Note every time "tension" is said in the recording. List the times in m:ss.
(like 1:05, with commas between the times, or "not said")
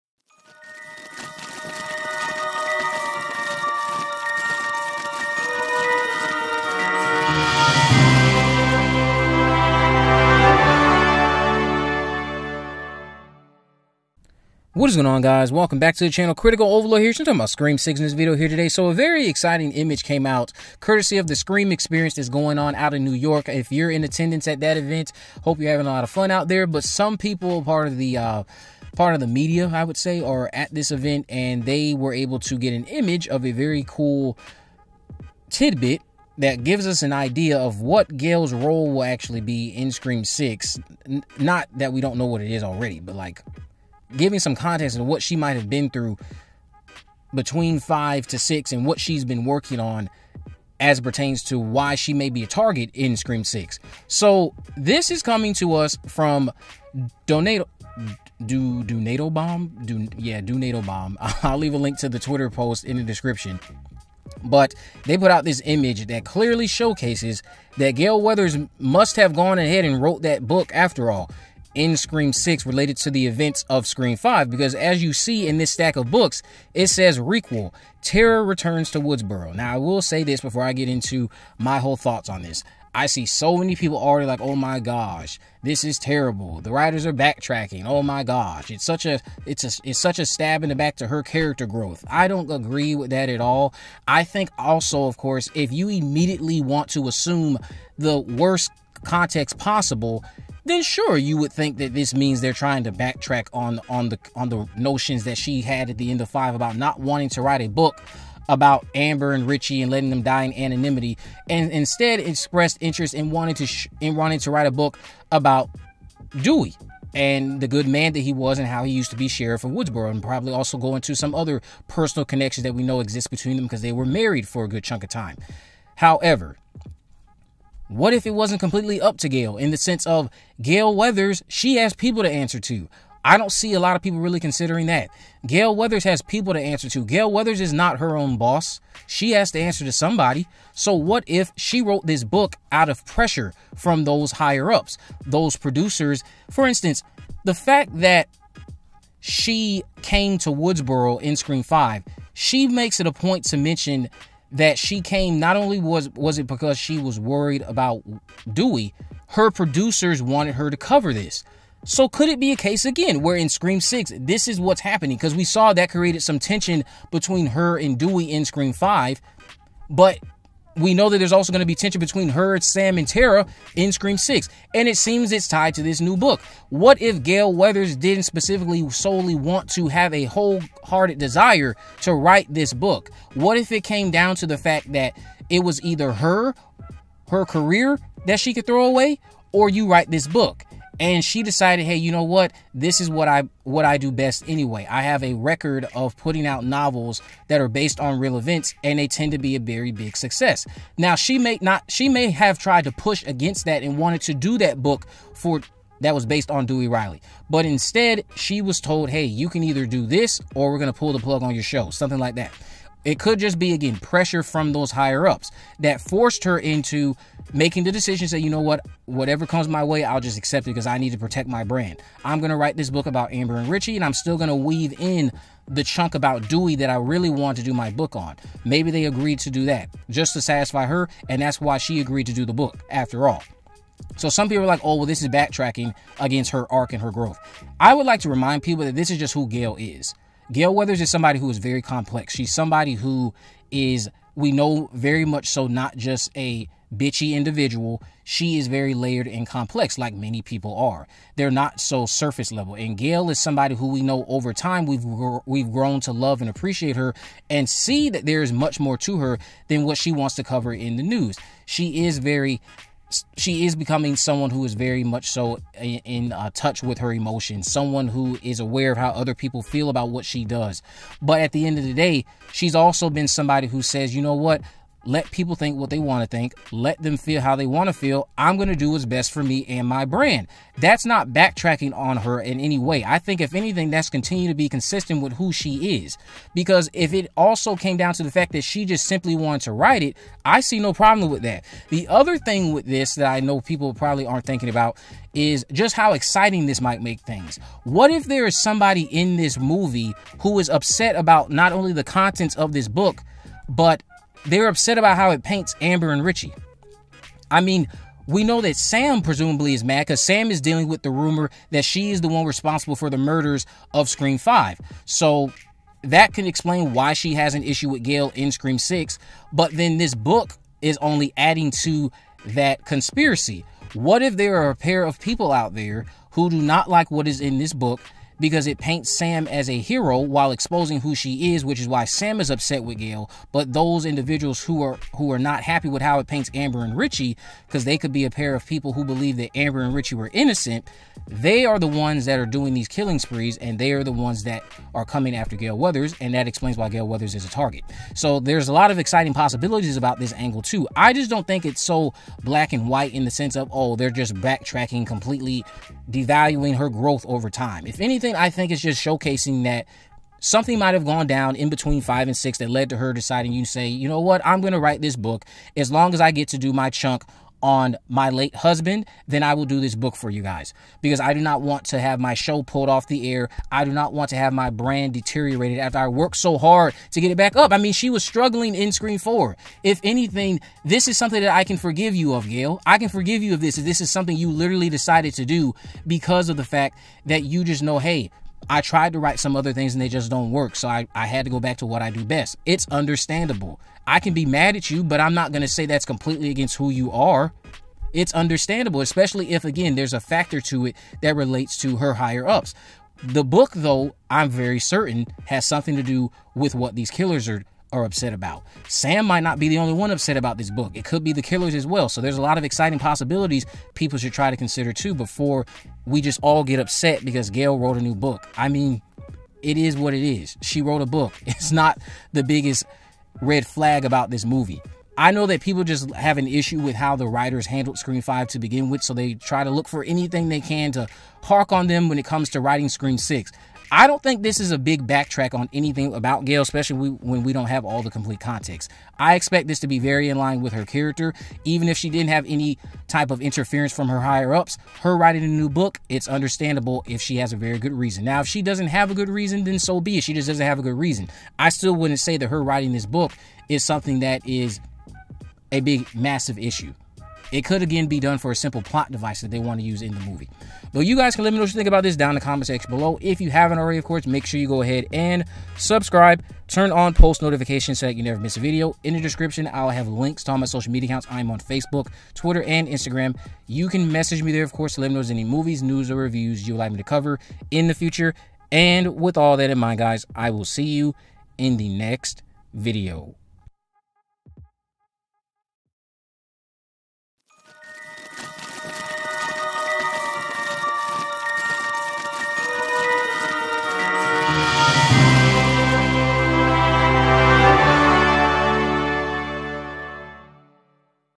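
2:46, 2:51.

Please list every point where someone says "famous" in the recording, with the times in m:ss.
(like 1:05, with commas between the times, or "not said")
not said.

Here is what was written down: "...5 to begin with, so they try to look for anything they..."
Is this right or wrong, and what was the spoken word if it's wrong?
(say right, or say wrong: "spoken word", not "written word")
right.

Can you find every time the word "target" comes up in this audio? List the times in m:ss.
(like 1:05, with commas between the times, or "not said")
0:52, 5:47.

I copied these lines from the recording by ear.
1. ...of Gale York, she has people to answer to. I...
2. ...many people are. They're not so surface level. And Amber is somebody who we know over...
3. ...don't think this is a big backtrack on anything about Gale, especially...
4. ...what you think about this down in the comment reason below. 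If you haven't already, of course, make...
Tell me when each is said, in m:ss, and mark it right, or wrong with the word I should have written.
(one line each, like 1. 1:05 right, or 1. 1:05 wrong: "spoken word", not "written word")
1. 2:10 wrong: "Weathers", not "York"
2. 4:10 wrong: "Gale", not "Amber"
3. 7:14 right
4. 7:41 wrong: "section", not "reason".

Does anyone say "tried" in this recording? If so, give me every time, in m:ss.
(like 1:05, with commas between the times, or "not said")
3:22, 6:28.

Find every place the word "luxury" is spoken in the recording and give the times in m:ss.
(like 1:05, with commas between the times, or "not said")
not said.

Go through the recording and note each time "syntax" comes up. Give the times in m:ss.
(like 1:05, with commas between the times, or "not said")
not said.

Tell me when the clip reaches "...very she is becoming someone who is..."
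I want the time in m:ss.
4:22.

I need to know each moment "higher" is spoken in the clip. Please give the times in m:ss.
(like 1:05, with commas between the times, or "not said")
2:24, 3:34, 6:42, 7:24.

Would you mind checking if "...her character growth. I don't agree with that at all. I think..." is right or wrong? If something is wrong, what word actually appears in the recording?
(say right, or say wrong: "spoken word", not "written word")
right.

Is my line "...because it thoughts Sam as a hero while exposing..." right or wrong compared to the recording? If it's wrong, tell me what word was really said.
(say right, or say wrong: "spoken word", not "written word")
wrong: "paints", not "thoughts".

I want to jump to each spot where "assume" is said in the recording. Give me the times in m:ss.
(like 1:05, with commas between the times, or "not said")
1:37.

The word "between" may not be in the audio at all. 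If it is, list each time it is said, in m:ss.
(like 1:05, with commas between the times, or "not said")
0:47, 2:03, 2:47, 2:51, 6:01.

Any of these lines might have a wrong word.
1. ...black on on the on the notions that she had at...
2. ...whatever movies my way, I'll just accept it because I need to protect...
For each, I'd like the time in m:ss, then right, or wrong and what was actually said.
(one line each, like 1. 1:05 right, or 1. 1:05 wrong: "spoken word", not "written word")
1. 1:42 wrong: "backtrack", not "black"
2. 3:39 wrong: "comes", not "movies".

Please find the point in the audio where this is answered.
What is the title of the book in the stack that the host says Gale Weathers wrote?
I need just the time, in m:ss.
1:17.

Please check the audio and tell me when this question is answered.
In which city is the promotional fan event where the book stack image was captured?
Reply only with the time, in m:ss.
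0:23.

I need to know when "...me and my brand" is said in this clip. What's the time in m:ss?
4:39.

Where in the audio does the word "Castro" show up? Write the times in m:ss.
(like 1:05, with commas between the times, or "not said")
not said.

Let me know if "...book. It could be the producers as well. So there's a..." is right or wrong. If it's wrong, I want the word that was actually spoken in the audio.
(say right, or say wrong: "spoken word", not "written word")
wrong: "killers", not "producers".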